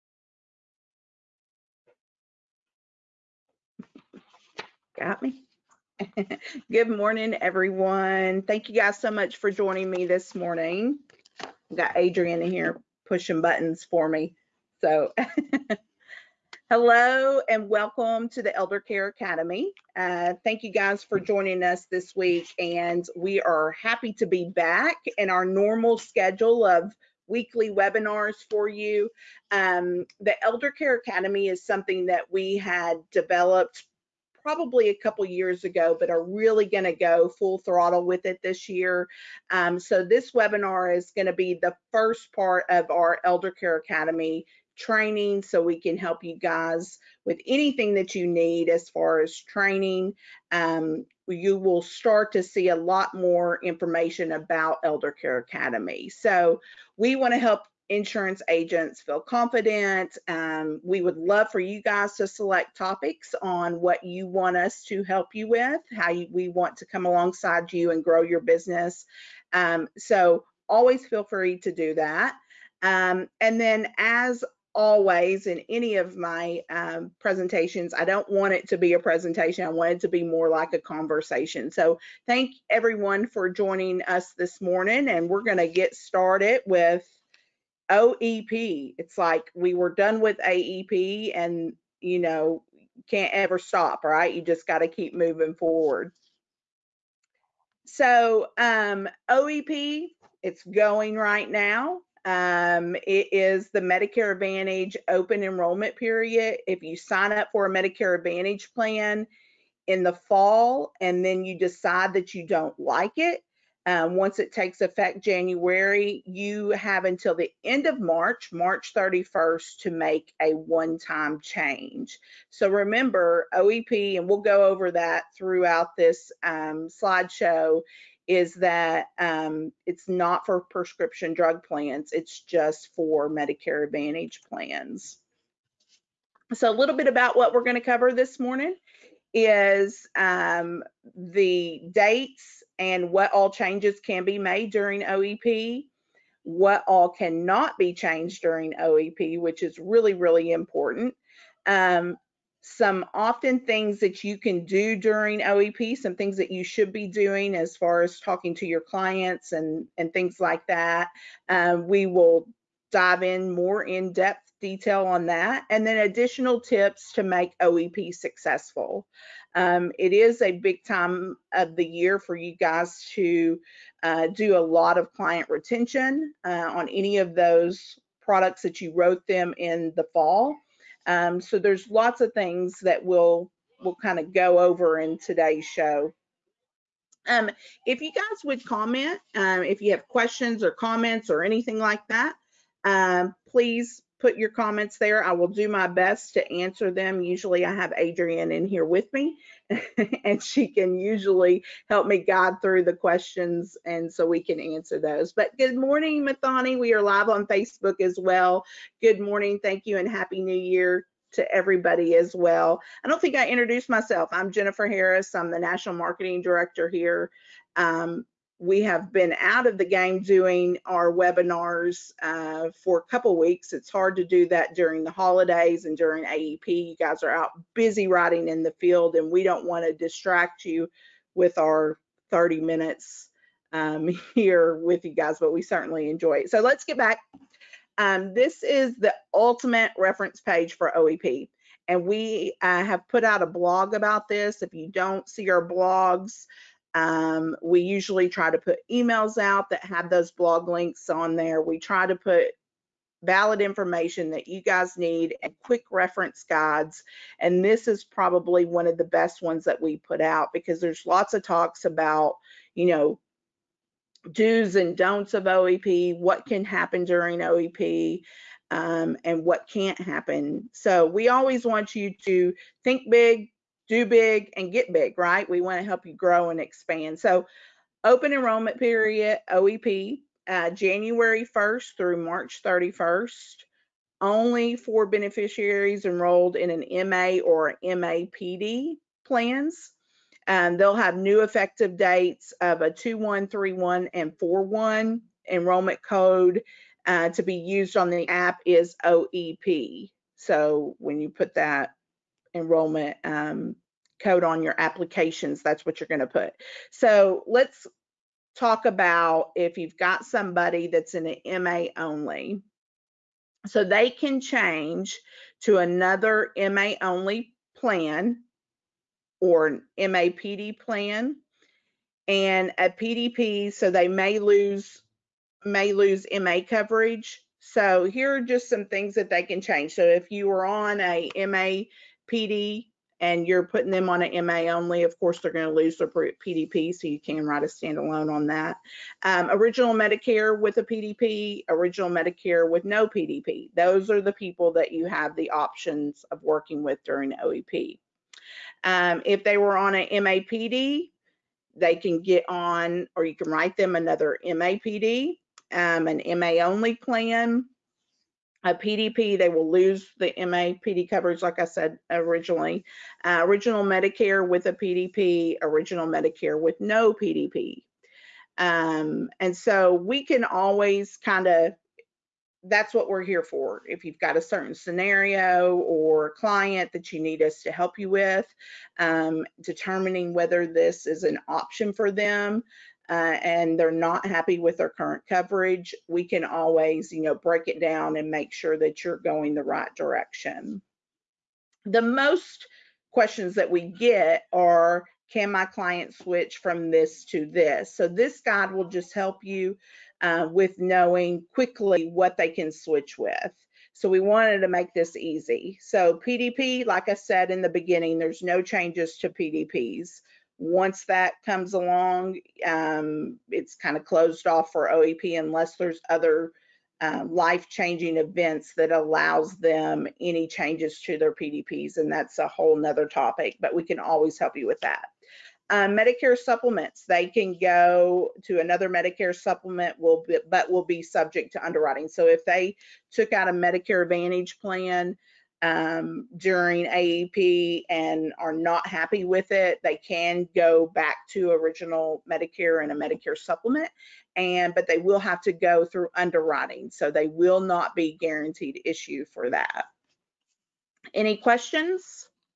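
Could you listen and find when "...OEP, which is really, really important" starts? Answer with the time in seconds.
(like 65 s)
148 s.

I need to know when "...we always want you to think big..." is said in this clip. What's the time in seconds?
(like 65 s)
271 s.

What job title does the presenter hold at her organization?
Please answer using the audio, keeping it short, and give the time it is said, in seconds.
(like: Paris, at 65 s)
National Marketing Director, at 215 s.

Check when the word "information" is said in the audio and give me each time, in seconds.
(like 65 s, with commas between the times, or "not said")
53 s, 253 s.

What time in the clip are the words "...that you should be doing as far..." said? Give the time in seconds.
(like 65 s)
156 s.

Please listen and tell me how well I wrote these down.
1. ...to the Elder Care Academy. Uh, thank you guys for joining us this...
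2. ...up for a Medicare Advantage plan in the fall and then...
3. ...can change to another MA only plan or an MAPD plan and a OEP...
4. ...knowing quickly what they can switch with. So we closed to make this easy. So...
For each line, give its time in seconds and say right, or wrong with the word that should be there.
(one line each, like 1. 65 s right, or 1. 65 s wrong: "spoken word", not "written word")
1. 18 s right
2. 107 s right
3. 314 s wrong: "PDP", not "OEP"
4. 400 s wrong: "wanted", not "closed".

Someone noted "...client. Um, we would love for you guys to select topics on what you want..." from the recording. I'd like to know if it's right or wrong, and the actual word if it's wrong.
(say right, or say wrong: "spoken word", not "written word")
wrong: "confident", not "client".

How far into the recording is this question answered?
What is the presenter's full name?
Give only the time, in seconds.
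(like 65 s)
214 s.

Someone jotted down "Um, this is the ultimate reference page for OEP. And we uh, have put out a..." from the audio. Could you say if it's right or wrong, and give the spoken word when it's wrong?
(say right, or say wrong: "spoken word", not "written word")
right.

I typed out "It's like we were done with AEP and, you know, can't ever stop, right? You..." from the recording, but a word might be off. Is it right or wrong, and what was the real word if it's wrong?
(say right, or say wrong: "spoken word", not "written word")
right.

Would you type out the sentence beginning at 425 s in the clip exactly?
Um, Medicare supplements, they can go to another Medicare supplement, will be, but will be subject to underwriting.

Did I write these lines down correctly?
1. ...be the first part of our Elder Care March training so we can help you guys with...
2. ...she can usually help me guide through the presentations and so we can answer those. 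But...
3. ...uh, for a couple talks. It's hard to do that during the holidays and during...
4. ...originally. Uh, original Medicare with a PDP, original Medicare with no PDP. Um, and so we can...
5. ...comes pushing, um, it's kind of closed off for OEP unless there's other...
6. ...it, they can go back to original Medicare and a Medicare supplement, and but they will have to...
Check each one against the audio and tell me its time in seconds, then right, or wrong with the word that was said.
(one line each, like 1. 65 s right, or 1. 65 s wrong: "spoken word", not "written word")
1. 41 s wrong: "Academy", not "March"
2. 200 s wrong: "questions", not "presentations"
3. 222 s wrong: "weeks", not "talks"
4. 362 s right
5. 411 s wrong: "along", not "pushing"
6. 439 s right.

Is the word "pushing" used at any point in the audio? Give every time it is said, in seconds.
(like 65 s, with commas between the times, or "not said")
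13 s.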